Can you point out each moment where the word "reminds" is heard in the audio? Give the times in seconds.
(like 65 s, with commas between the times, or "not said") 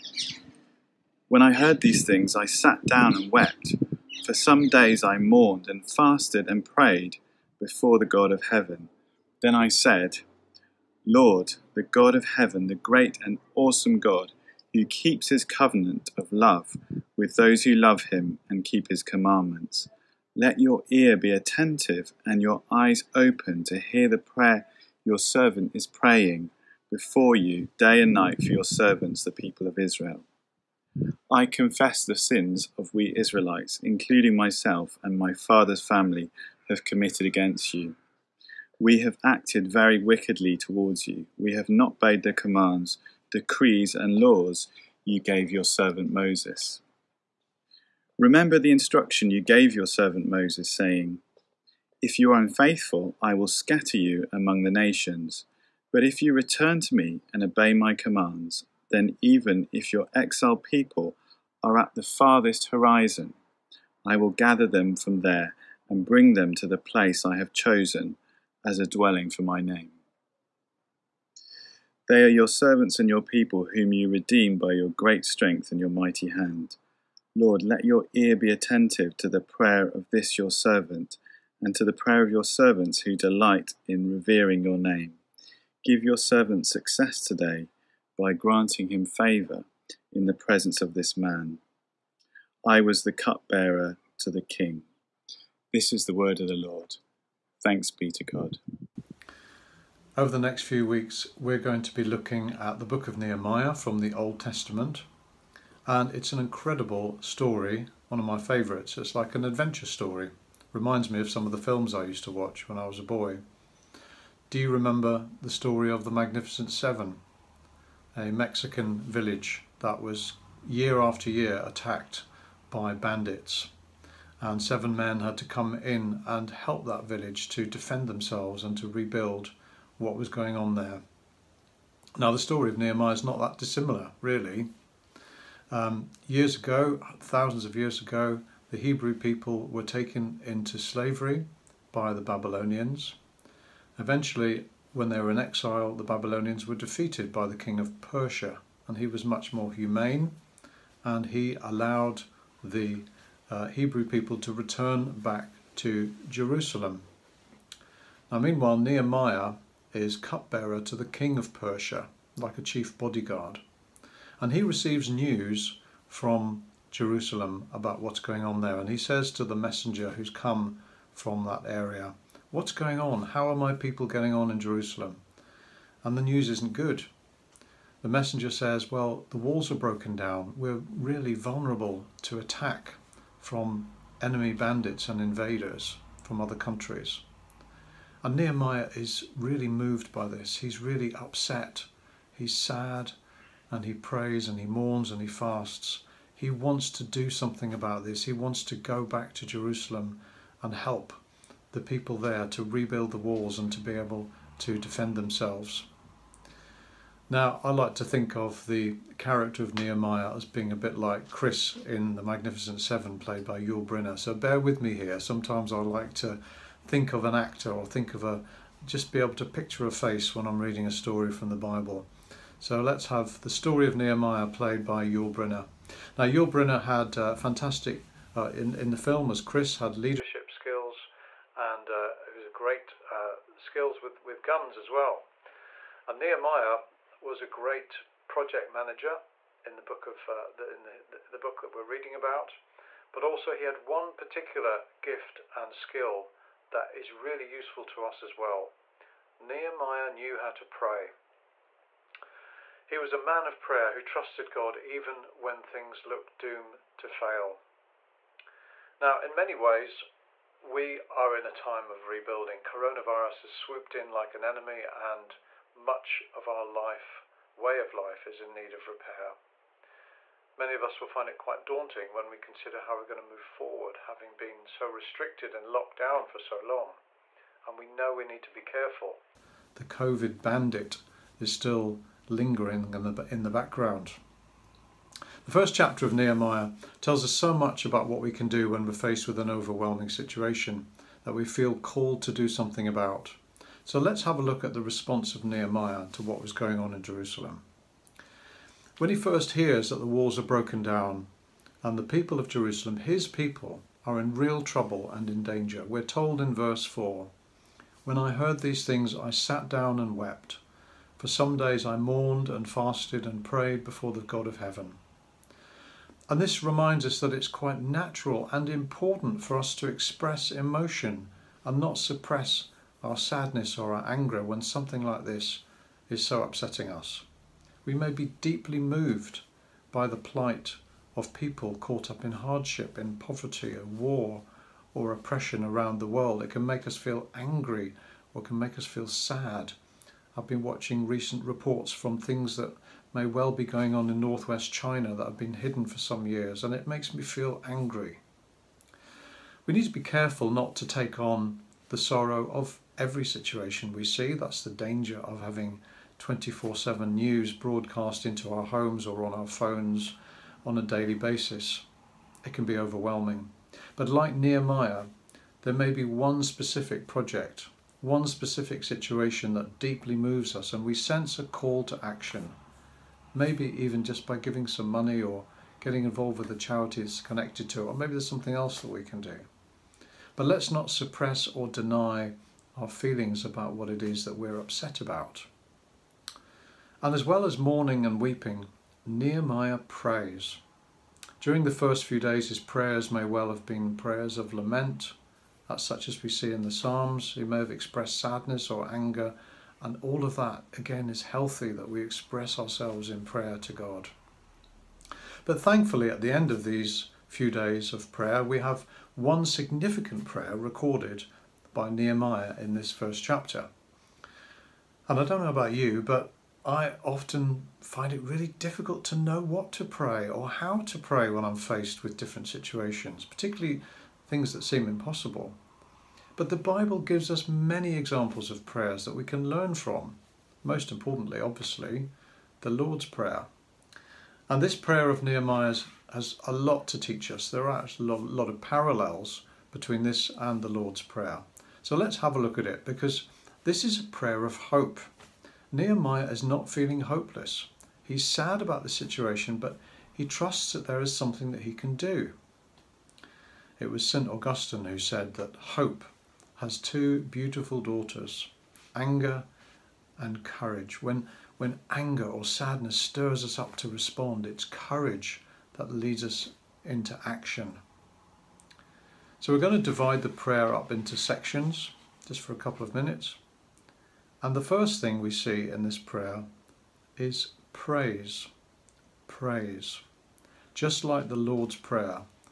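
110 s, 316 s.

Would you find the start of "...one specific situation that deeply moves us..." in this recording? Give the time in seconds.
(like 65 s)
368 s.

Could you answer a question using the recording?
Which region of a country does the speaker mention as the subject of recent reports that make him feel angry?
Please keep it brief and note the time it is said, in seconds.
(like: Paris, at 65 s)
northwest China, at 344 s.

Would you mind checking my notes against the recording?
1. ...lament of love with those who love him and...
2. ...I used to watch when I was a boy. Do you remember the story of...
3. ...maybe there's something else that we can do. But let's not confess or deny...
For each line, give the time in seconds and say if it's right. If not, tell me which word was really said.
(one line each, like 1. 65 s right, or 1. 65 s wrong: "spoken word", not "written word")
1. 15 s wrong: "covenant", not "lament"
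2. 111 s right
3. 377 s wrong: "suppress", not "confess".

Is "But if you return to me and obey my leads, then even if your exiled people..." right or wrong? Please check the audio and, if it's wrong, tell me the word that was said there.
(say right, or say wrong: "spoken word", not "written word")
wrong: "commands", not "leads".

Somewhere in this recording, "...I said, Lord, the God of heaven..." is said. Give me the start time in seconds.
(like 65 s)
9 s.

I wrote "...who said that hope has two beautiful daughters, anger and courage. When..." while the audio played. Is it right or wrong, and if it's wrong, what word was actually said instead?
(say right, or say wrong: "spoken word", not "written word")
right.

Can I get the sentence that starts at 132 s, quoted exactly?
Now, the story of Nehemiah is not that dissimilar, really.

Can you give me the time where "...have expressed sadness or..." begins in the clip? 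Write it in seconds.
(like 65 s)
397 s.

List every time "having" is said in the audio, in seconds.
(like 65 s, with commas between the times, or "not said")
274 s, 355 s.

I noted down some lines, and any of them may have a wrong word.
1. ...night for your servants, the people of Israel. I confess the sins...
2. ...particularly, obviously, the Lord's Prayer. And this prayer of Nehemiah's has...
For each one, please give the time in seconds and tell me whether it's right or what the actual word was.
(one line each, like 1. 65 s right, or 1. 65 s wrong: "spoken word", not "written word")
1. 28 s right
2. 430 s wrong: "importantly", not "particularly".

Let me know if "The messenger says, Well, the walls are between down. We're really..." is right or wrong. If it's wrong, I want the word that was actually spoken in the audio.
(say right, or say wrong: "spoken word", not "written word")
wrong: "broken", not "between".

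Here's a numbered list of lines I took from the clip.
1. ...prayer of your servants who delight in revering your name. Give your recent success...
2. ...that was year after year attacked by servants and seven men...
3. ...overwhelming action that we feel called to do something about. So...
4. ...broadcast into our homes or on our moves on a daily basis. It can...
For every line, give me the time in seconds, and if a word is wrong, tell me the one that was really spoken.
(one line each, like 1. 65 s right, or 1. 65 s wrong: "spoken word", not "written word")
1. 81 s wrong: "servant", not "recent"
2. 119 s wrong: "bandits", not "servants"
3. 289 s wrong: "situation", not "action"
4. 357 s wrong: "phones", not "moves".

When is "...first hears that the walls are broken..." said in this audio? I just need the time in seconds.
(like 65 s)
299 s.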